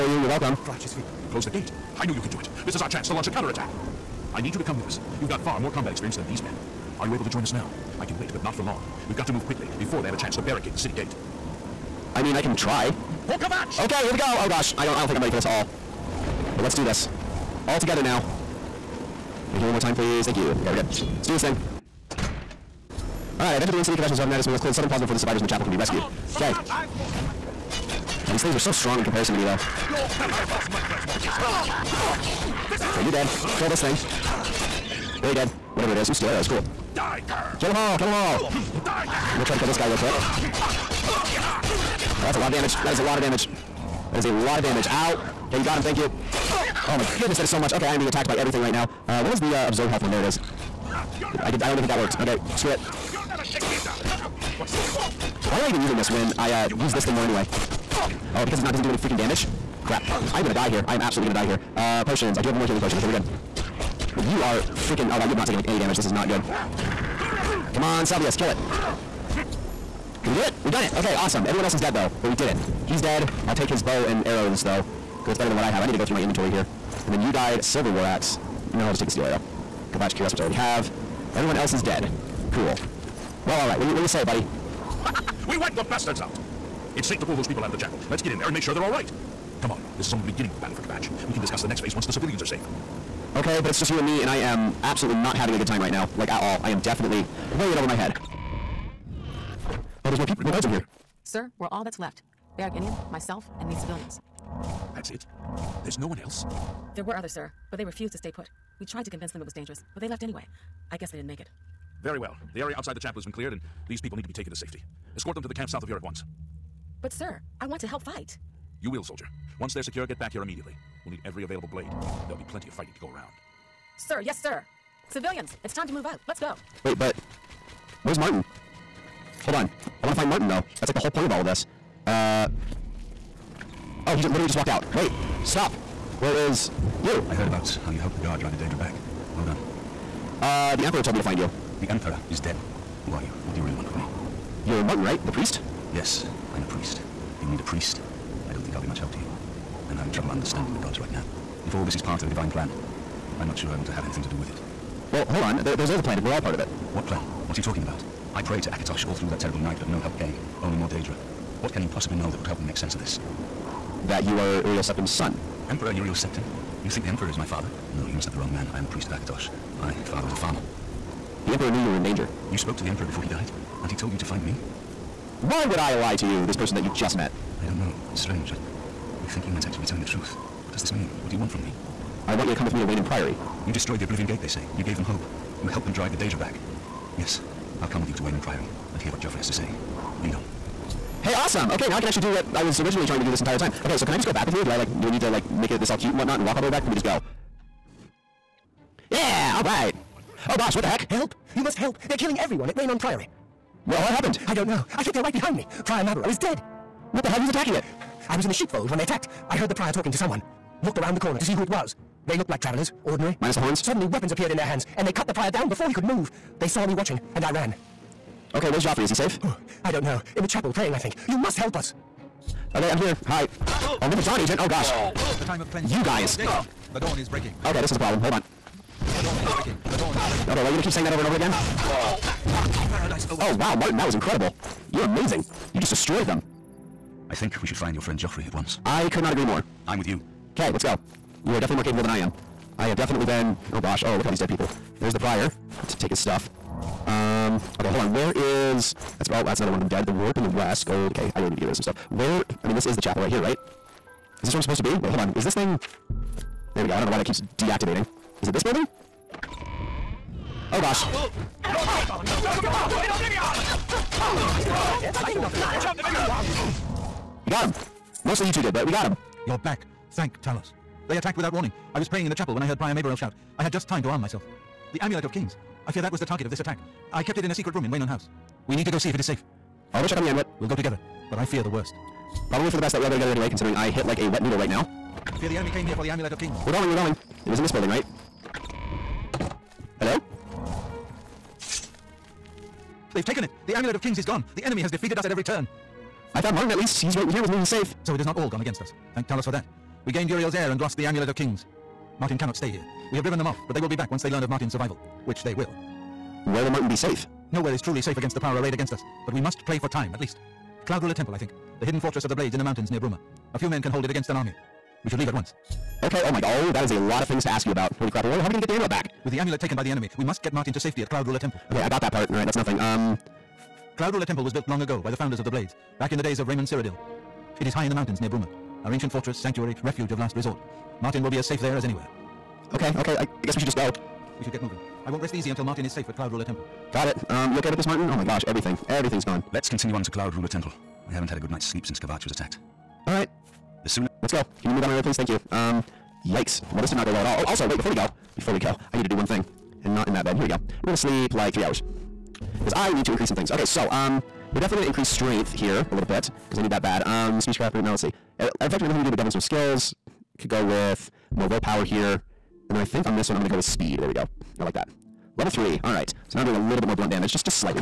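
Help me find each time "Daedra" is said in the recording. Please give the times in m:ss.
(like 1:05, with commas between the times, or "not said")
2:18, 2:40, 3:06.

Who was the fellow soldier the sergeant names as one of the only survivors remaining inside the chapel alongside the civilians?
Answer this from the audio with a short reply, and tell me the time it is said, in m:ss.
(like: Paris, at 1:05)
Berich Inian, at 1:42.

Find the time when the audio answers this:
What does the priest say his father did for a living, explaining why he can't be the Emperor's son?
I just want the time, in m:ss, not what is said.
2:50.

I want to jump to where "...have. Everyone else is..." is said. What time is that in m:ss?
1:20.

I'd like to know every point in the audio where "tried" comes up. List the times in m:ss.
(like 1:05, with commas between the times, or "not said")
1:48.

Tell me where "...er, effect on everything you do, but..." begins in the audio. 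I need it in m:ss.
5:58.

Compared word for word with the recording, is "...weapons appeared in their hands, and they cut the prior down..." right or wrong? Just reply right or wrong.
right.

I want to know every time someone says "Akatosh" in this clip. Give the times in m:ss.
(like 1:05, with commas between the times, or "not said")
2:38, 2:49.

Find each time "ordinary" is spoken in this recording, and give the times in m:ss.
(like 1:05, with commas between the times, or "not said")
3:33.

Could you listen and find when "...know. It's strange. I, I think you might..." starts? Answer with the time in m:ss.
2:57.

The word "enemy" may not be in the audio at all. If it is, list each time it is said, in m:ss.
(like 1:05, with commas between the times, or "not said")
4:45, 4:54, 5:19.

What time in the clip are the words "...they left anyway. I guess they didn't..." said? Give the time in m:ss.
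1:50.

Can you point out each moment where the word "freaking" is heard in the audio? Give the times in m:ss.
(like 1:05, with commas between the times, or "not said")
0:58, 1:04.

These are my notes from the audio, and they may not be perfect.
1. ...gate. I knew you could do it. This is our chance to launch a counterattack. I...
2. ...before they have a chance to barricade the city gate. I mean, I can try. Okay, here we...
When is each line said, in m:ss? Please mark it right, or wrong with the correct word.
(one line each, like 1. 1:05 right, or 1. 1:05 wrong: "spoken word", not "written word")
1. 0:01 right
2. 0:09 right.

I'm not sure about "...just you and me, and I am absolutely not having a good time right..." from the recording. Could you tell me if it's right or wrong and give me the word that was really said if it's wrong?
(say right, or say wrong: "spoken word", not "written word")
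right.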